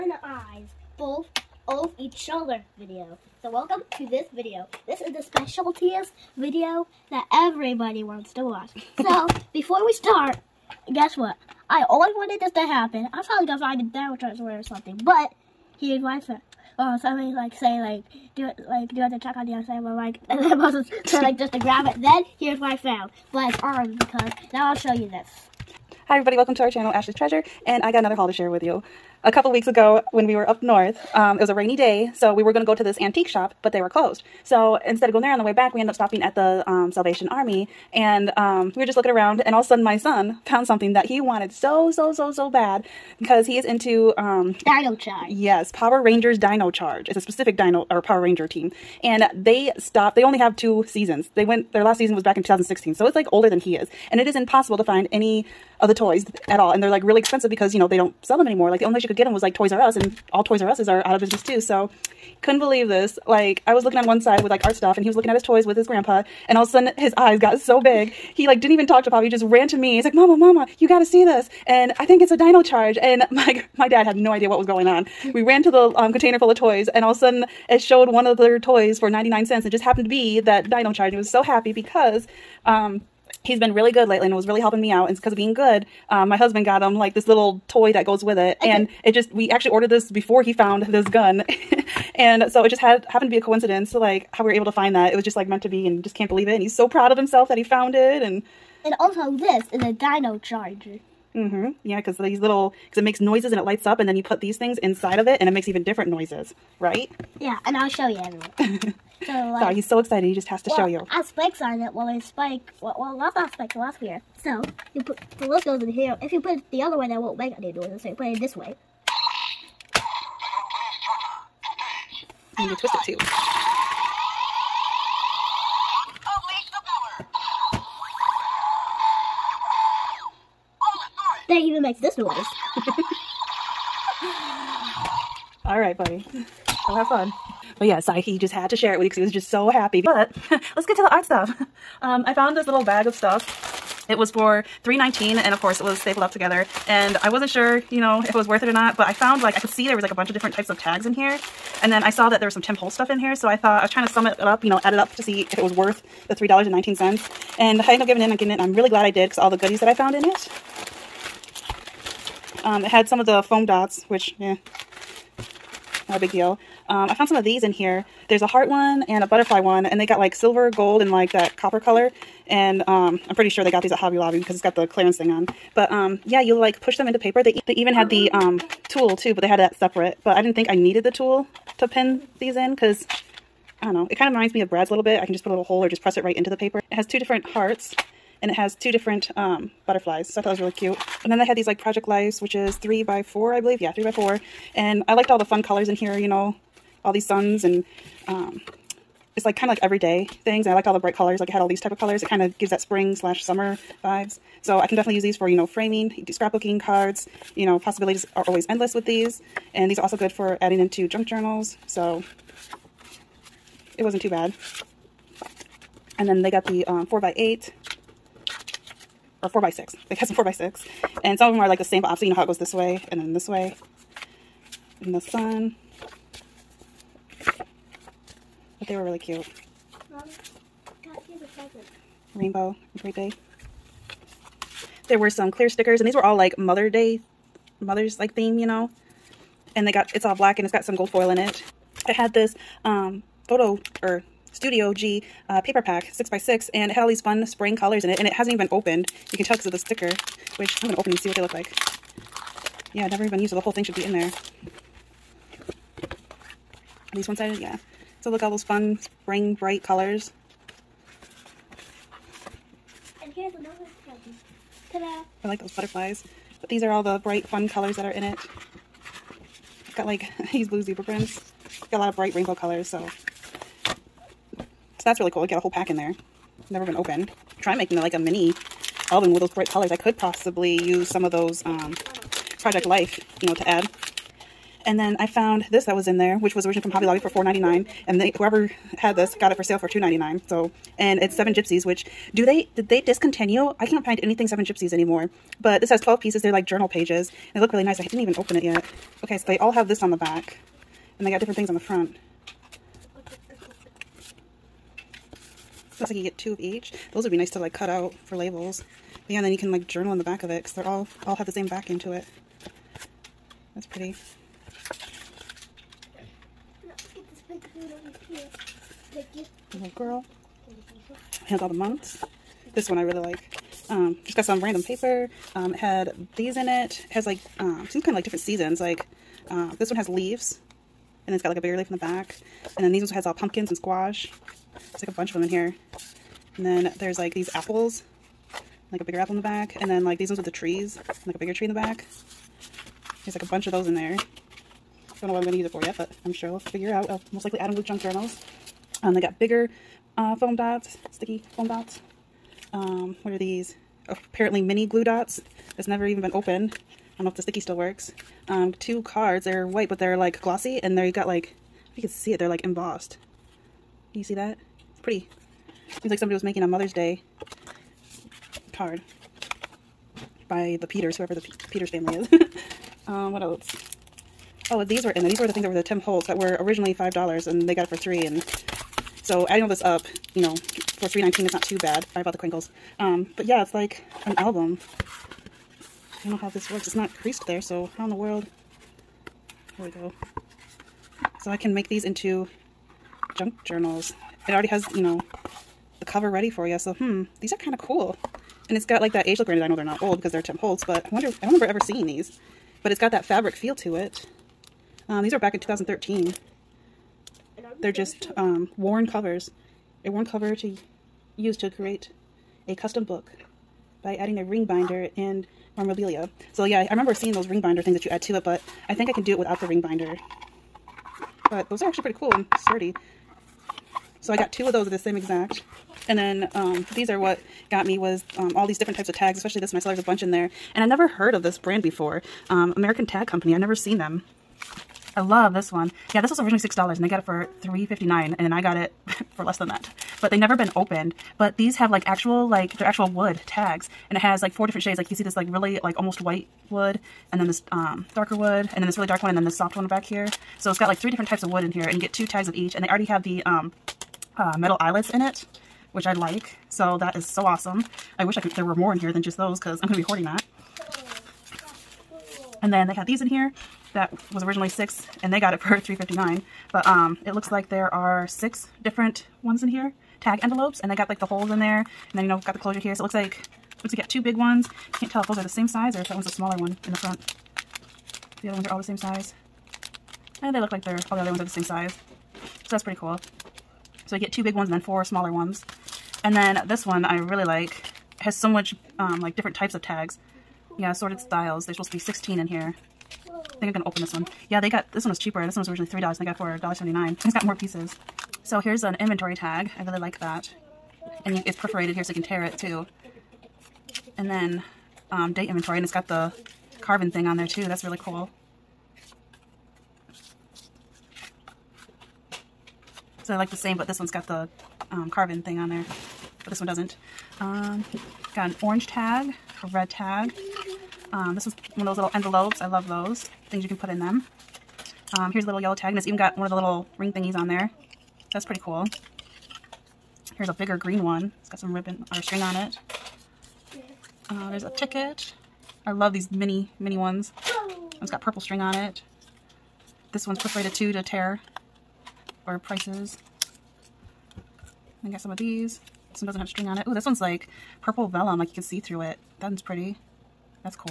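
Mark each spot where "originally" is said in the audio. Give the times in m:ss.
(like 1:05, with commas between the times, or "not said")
4:46, 6:16, 7:16, 7:44, 8:15.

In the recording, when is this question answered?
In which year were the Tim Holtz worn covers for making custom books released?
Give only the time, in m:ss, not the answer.
6:45.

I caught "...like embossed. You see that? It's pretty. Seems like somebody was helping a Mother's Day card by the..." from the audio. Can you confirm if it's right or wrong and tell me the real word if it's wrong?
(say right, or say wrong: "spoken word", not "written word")
wrong: "making", not "helping".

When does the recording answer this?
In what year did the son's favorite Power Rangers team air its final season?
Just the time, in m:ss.
0:52.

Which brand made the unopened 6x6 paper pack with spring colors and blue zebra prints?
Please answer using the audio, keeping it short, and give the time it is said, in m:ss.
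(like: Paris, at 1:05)
Studio G, at 4:04.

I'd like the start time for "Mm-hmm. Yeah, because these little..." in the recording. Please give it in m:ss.
1:41.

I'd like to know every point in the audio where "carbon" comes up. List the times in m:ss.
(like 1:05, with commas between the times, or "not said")
8:26, 8:35.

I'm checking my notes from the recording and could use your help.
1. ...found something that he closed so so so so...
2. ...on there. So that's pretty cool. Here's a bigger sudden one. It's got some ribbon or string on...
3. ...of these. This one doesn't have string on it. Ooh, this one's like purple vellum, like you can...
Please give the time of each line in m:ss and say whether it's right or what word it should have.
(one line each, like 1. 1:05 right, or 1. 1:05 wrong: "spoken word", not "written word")
1. 0:40 wrong: "wanted", not "closed"
2. 8:47 wrong: "green", not "sudden"
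3. 9:05 right.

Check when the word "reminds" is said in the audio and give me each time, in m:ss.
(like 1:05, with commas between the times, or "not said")
3:04.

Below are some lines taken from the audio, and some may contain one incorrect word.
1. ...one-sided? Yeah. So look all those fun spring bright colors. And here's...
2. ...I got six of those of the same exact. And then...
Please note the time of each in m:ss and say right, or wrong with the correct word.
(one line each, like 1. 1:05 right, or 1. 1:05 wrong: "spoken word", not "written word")
1. 4:17 right
2. 7:04 wrong: "two", not "six".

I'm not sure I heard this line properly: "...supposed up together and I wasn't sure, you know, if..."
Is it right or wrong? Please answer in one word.
wrong.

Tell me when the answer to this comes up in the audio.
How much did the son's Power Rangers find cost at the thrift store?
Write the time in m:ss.
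1:19.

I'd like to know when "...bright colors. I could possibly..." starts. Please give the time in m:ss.
4:39.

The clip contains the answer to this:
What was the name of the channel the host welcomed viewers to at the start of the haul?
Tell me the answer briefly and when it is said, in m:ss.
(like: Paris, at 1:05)
Ashley's Treasure, at 0:26.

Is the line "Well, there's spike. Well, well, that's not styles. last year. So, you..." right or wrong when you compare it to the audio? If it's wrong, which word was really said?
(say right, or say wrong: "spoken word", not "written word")
wrong: "spikes", not "styles".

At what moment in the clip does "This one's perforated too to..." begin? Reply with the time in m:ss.
9:00.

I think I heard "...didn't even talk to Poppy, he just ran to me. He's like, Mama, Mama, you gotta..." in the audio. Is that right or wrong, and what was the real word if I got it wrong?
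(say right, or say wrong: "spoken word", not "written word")
right.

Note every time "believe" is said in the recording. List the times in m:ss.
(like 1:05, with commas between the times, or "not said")
1:02, 1:36, 3:13.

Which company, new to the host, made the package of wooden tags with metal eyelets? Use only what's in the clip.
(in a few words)
American Tag Company.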